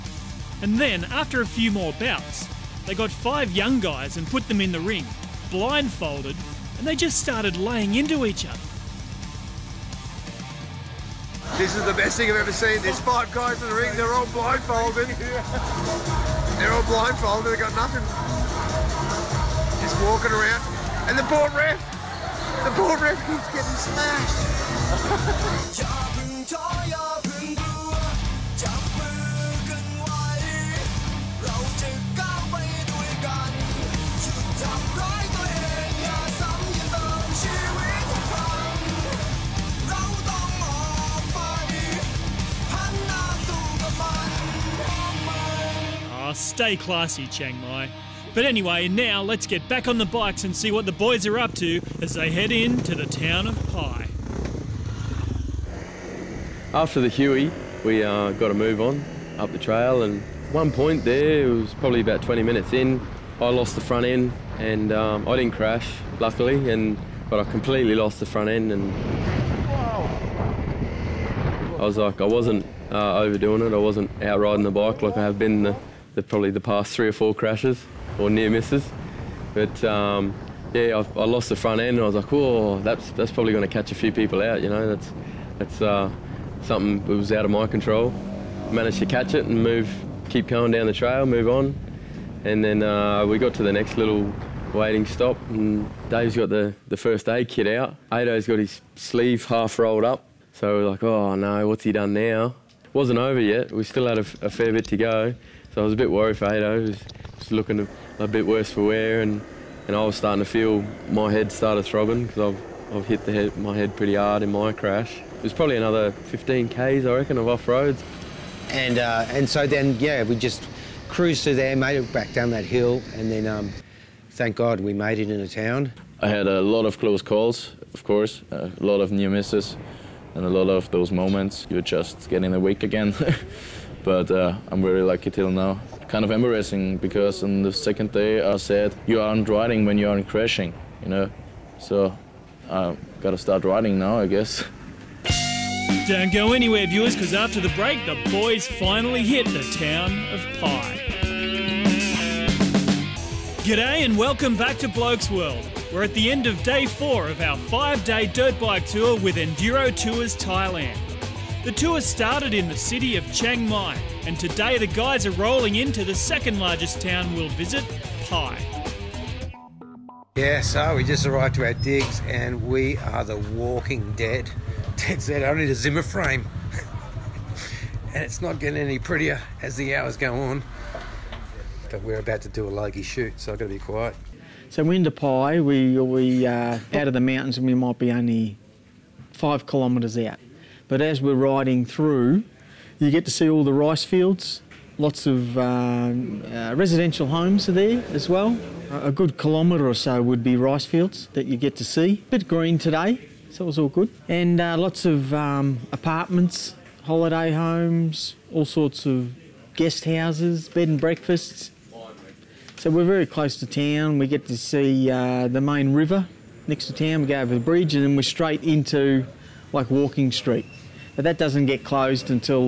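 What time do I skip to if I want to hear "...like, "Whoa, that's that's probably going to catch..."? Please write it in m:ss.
1:22.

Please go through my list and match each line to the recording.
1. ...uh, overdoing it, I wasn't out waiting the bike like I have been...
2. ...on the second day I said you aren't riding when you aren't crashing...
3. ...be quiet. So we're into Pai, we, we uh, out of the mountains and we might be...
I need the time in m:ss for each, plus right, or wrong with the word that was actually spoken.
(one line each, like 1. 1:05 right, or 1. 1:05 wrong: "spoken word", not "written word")
1. 1:12 wrong: "riding", not "waiting"
2. 2:17 right
3. 3:03 right.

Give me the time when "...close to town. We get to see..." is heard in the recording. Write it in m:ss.
3:33.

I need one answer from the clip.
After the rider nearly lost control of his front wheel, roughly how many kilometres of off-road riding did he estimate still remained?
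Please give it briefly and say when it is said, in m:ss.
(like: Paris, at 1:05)
15, at 1:56.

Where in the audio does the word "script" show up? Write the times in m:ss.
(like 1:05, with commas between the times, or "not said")
not said.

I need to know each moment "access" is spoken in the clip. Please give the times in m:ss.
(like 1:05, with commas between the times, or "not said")
not said.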